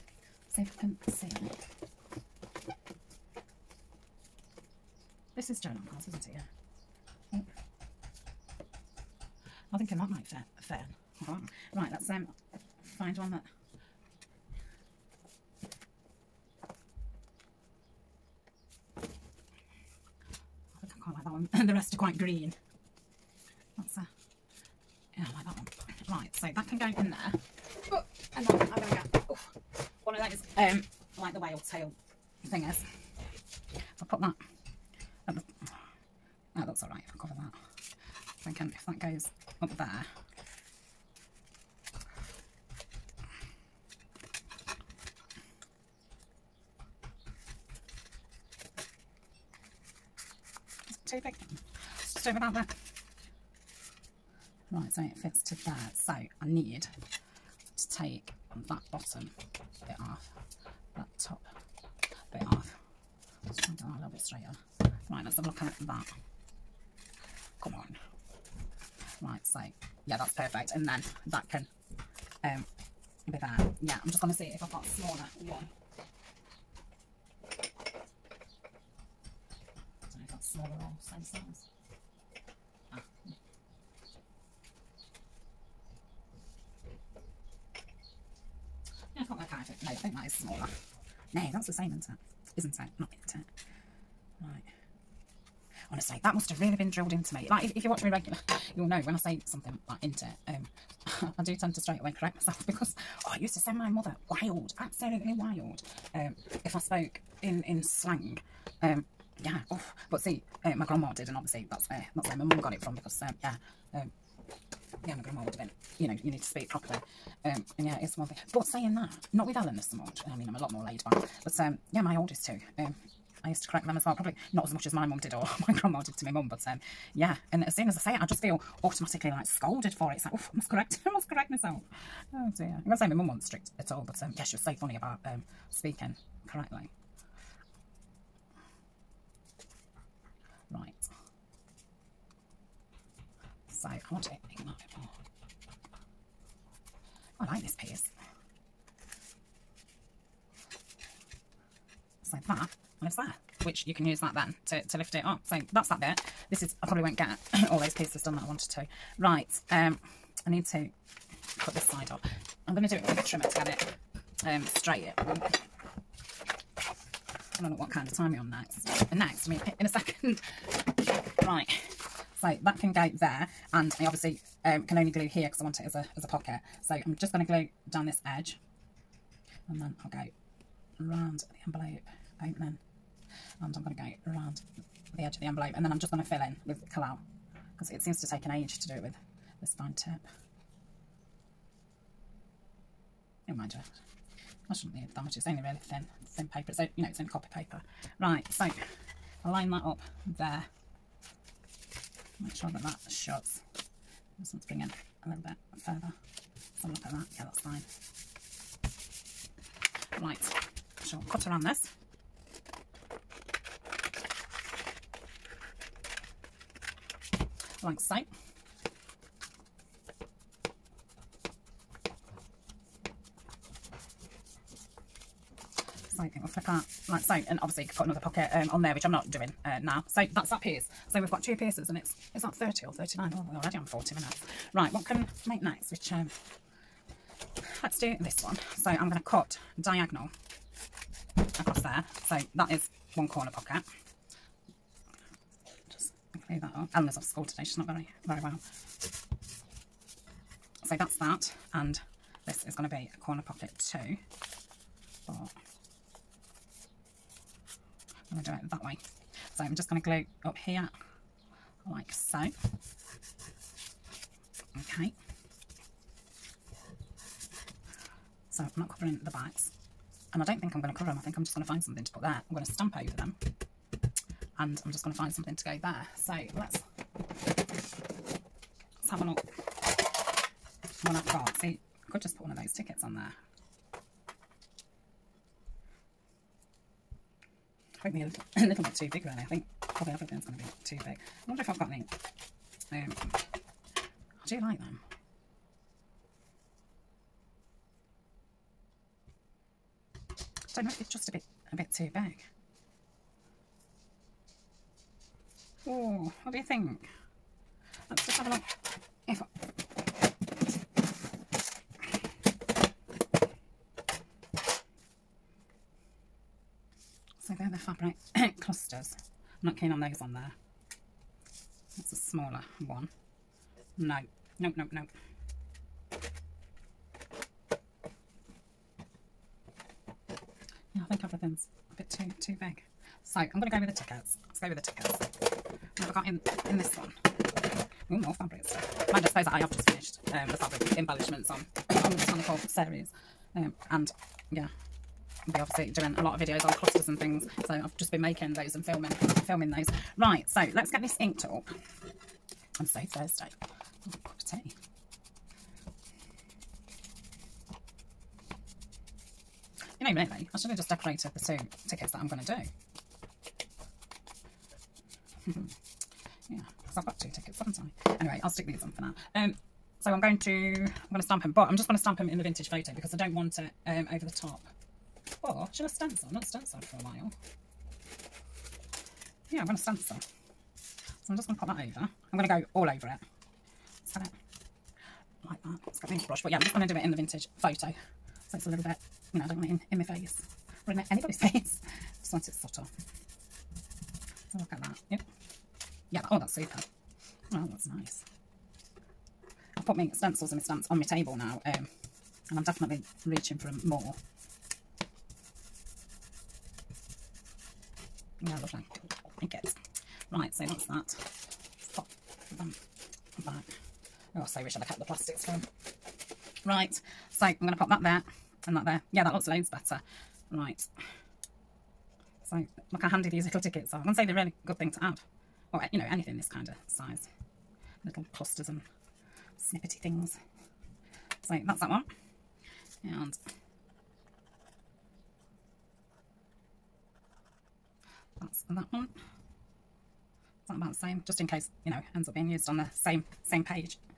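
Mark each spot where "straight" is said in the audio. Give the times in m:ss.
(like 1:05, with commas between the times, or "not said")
1:41, 2:44.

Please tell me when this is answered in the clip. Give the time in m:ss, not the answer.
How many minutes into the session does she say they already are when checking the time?
3:53.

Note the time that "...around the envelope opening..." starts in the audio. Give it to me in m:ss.
3:00.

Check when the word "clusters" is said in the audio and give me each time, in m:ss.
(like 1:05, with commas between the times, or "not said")
5:18, 5:46, 7:08.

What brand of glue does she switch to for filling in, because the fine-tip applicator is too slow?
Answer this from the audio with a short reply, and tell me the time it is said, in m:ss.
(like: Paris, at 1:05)
Collall, at 3:06.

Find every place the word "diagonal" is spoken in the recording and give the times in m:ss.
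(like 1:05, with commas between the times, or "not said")
3:59.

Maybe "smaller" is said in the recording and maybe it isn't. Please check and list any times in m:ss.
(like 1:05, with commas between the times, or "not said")
1:14, 5:22.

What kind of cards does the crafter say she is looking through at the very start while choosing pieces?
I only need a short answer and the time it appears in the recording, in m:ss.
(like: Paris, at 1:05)
Journal cards, at 0:05.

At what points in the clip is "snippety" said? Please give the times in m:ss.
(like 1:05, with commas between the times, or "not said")
7:09.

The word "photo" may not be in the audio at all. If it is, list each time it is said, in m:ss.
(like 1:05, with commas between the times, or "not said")
6:12, 6:27.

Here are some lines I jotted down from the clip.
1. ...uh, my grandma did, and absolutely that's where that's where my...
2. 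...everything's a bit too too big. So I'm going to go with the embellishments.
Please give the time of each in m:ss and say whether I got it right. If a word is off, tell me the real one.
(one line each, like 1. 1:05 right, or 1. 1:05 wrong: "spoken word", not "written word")
1. 1:50 wrong: "obviously", not "absolutely"
2. 5:31 wrong: "tickets", not "embellishments".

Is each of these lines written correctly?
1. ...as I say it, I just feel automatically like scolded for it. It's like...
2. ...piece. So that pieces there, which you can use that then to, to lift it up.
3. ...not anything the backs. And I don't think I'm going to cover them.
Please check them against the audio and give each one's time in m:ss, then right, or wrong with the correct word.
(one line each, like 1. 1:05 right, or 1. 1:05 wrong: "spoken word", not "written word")
1. 2:07 right
2. 2:27 wrong: "lives", not "pieces"
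3. 4:28 wrong: "covering", not "anything".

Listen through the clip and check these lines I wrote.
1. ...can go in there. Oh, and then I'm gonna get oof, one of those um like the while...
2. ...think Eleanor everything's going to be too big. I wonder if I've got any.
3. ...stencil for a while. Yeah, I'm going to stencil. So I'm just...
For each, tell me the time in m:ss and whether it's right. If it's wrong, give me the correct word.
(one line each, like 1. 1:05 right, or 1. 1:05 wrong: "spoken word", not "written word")
1. 0:26 wrong: "whale", not "while"
2. 4:49 wrong: "Probably", not "Eleanor"
3. 6:16 right.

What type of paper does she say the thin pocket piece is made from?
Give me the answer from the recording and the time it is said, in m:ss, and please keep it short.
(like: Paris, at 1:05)
Copy paper, at 3:17.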